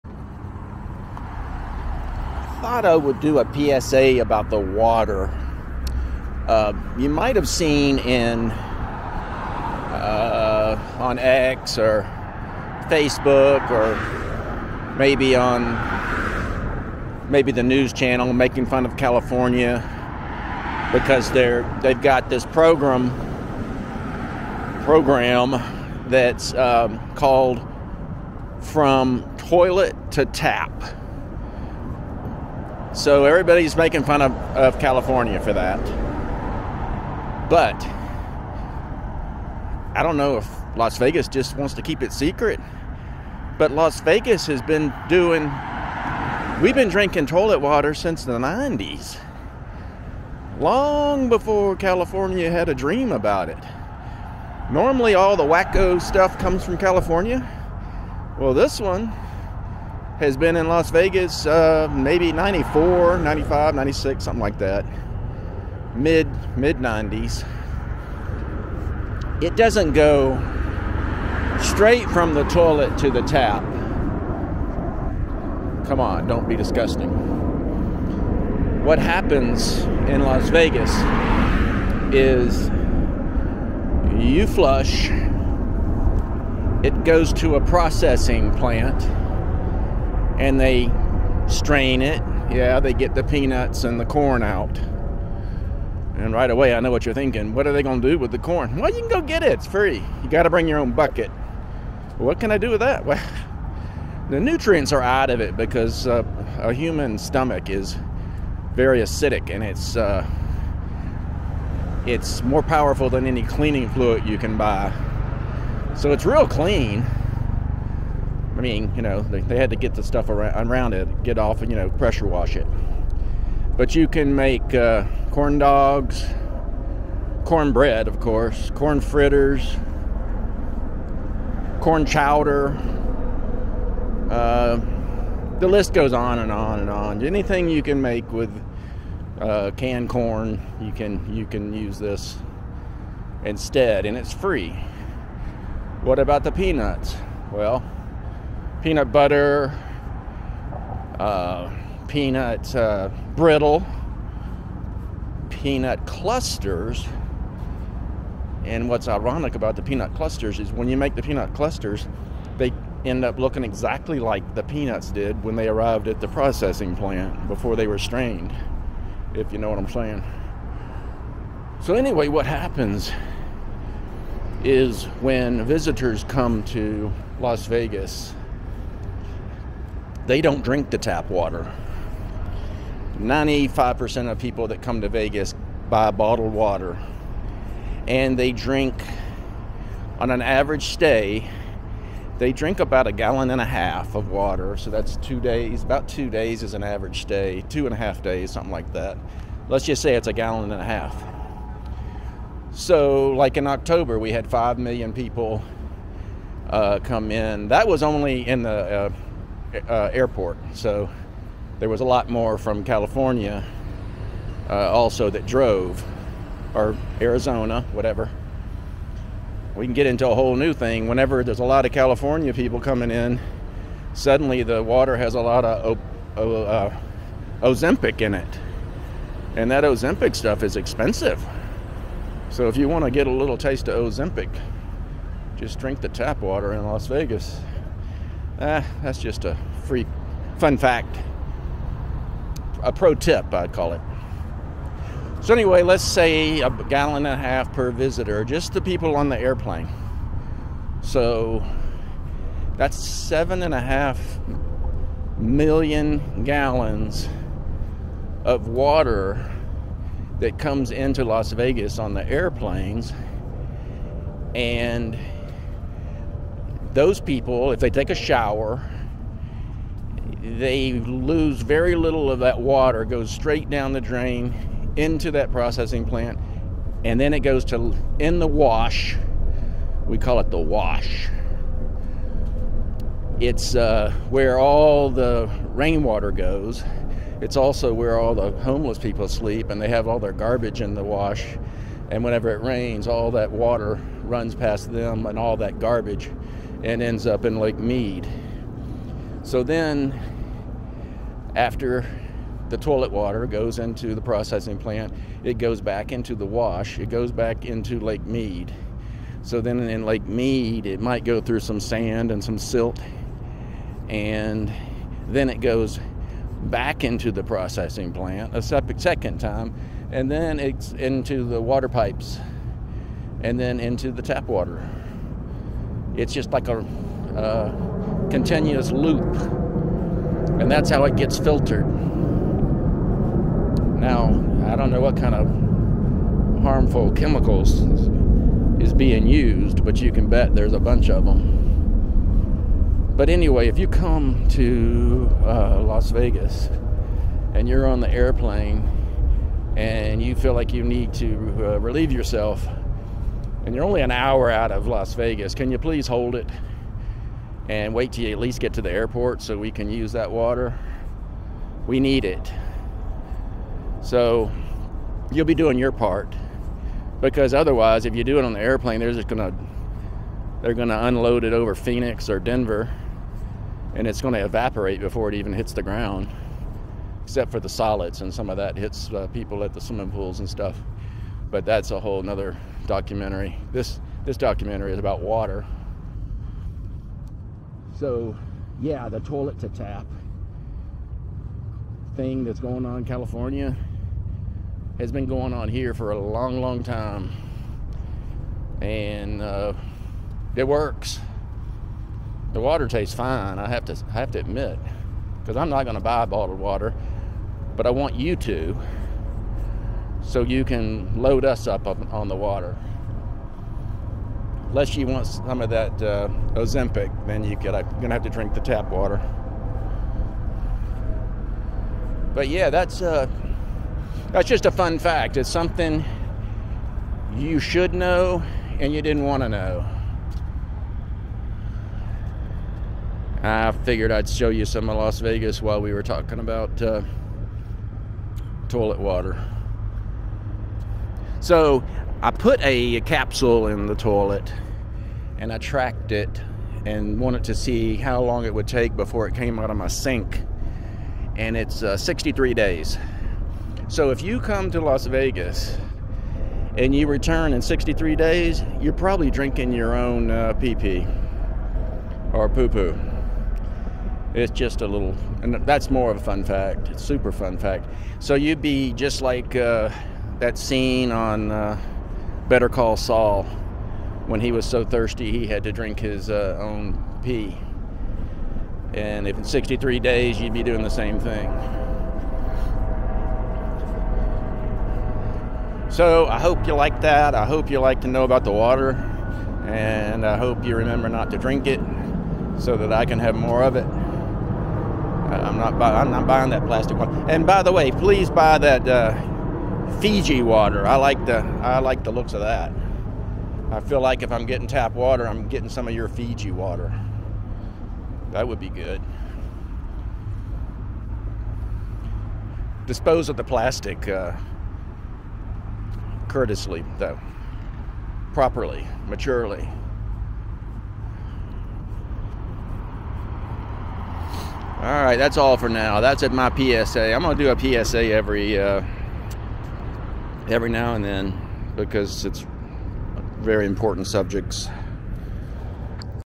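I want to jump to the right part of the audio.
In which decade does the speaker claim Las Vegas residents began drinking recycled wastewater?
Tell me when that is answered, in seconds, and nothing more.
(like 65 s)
48 s.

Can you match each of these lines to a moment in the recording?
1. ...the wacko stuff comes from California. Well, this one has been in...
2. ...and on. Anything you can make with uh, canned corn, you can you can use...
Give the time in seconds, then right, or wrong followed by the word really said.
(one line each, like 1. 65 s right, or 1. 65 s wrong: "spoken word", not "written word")
1. 55 s right
2. 136 s right.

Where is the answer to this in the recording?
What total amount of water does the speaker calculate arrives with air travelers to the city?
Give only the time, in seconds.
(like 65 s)
252 s.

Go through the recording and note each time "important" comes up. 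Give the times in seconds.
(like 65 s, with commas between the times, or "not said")
533 s.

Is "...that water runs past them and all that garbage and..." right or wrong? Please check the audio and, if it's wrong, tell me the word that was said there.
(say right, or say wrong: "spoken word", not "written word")
right.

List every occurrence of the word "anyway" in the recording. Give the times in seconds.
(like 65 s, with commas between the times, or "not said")
171 s, 245 s, 343 s.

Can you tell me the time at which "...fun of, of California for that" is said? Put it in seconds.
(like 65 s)
34 s.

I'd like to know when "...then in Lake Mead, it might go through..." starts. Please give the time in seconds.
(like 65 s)
309 s.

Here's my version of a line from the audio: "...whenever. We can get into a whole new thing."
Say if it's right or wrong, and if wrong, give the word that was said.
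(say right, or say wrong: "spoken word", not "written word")
wrong: "whatever", not "whenever".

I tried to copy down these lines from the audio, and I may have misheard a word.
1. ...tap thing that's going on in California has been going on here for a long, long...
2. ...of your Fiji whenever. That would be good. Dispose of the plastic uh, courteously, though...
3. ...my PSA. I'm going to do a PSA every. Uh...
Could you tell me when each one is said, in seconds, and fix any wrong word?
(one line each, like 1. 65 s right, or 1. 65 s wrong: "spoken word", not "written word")
1. 389 s right
2. 505 s wrong: "water", not "whenever"
3. 526 s right.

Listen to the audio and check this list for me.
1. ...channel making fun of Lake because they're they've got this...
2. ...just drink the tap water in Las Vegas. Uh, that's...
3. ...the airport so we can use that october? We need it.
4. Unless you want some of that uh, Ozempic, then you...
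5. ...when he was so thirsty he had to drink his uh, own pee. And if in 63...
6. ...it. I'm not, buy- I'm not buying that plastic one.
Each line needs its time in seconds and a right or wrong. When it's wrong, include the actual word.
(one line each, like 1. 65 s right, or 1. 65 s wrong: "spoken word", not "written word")
1. 17 s wrong: "California", not "Lake"
2. 235 s right
3. 358 s wrong: "water", not "october"
4. 414 s right
5. 474 s right
6. 493 s right.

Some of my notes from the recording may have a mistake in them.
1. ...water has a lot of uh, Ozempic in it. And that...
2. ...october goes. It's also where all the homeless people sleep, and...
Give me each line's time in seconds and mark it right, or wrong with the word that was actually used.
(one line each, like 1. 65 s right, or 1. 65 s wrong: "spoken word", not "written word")
1. 224 s right
2. 285 s wrong: "rainwater", not "october".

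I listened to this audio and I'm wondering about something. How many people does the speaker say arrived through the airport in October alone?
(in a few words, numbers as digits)
5 million.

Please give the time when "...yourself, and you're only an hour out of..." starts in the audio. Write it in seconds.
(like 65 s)
352 s.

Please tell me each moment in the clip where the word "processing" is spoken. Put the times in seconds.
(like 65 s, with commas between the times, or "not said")
87 s, 166 s, 275 s, 304 s, 317 s.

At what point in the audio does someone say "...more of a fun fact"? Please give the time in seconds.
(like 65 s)
465 s.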